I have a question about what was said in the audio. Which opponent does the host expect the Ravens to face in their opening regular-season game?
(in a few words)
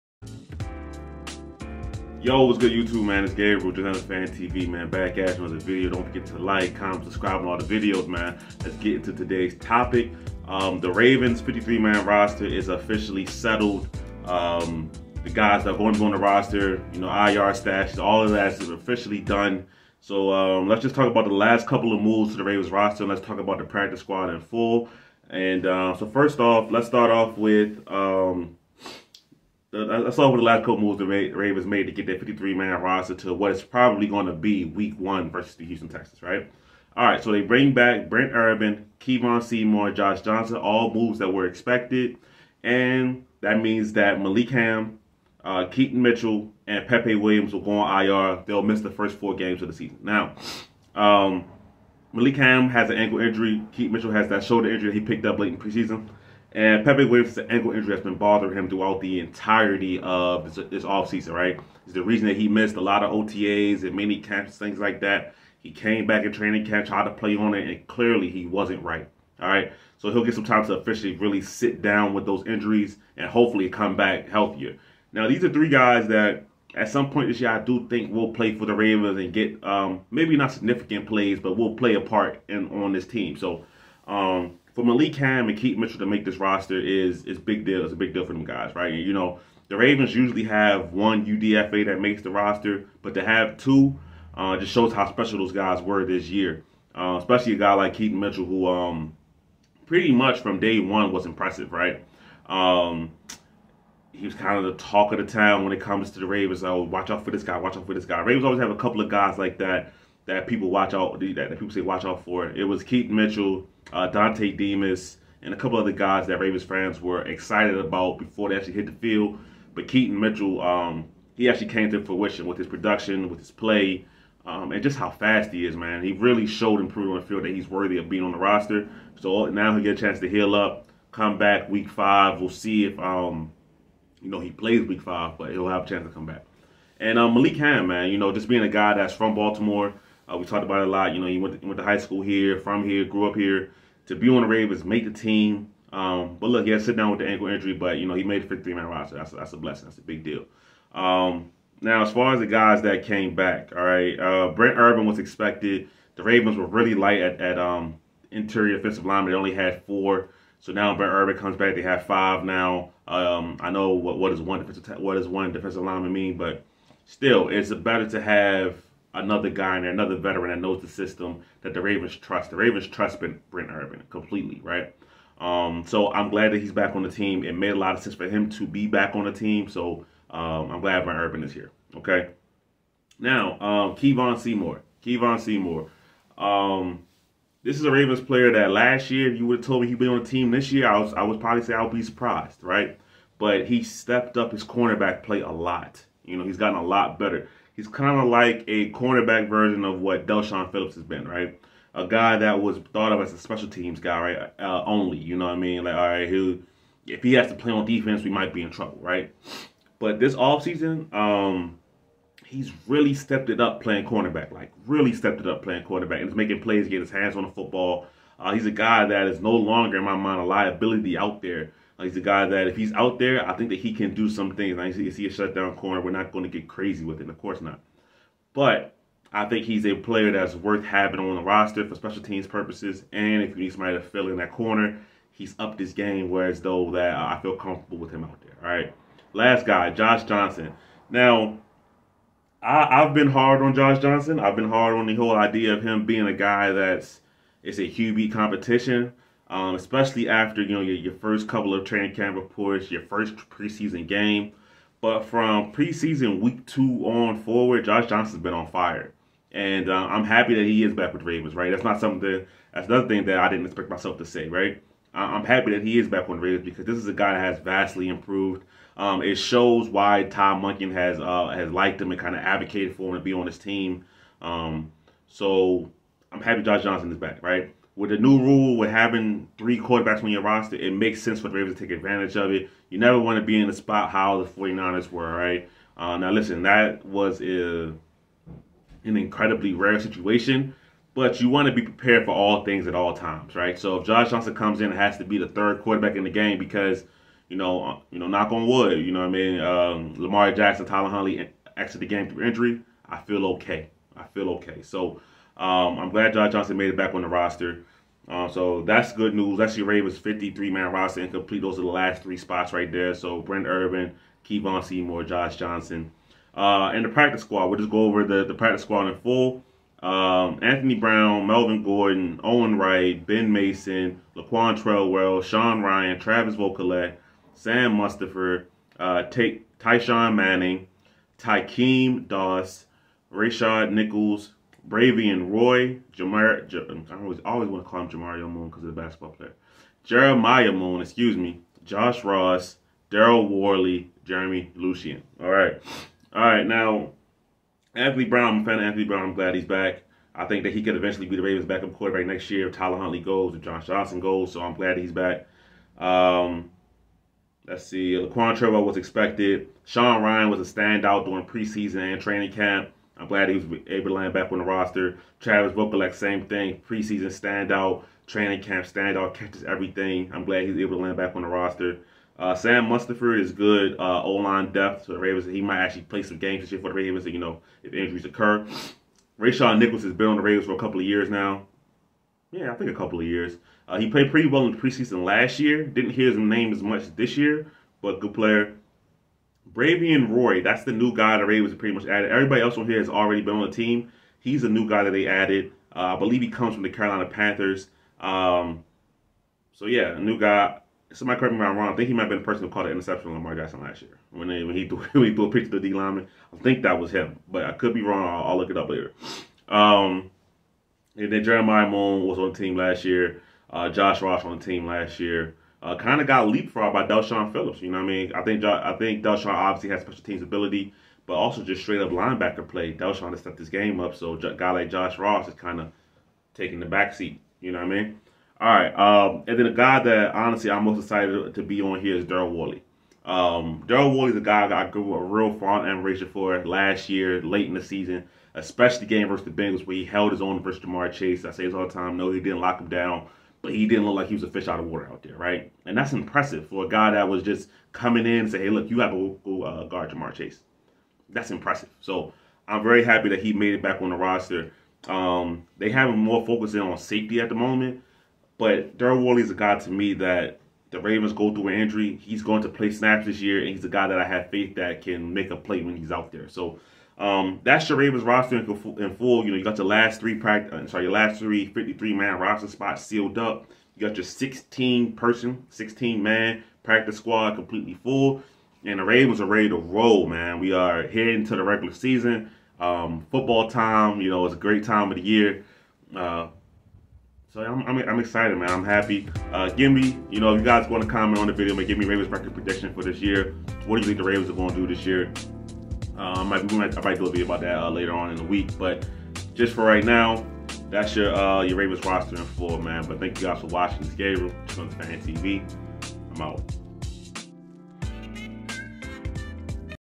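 Houston Texans.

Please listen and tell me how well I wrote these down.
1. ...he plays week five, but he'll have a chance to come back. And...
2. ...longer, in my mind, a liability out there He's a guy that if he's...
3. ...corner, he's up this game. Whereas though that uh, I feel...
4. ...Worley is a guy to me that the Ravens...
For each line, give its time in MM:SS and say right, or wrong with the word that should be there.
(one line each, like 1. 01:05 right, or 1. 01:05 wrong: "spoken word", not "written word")
1. 02:14 right
2. 03:39 right
3. 03:54 right
4. 07:39 right.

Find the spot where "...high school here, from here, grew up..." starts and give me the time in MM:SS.
02:21.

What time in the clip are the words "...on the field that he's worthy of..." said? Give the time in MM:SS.
02:07.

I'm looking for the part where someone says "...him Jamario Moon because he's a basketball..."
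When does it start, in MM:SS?
05:38.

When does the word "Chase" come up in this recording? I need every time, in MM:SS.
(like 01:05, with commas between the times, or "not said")
07:21, 07:30.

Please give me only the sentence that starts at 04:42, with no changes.
You never want to be in the spot how the 49ers were, right?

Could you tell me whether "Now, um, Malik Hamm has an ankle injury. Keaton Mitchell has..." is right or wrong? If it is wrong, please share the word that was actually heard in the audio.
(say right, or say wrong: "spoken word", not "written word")
right.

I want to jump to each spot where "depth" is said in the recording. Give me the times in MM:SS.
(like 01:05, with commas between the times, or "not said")
06:14.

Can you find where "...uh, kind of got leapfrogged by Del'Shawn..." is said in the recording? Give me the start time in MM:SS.
06:55.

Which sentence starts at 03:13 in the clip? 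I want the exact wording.
But he stepped up his cornerback play a lot.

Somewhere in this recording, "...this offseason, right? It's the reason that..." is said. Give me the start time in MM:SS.
01:00.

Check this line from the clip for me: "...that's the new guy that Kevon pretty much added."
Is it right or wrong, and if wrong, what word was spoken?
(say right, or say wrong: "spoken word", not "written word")
wrong: "Ravens", not "Kevon".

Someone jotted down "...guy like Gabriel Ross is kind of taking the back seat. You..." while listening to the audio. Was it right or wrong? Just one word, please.
wrong.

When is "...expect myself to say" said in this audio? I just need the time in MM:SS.
04:23.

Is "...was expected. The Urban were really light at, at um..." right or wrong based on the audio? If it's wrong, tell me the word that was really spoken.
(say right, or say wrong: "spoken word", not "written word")
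wrong: "Ravens", not "Urban".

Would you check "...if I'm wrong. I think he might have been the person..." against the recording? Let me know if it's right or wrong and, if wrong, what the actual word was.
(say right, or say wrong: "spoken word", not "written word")
right.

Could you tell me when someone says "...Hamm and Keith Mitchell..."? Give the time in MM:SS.
01:25.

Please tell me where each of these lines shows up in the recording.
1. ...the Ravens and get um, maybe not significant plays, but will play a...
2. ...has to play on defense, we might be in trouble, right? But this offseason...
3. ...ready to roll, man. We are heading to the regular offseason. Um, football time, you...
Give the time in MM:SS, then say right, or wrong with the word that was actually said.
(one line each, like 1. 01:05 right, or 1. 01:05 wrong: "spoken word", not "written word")
1. 01:18 right
2. 03:27 right
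3. 07:59 wrong: "season", not "offseason".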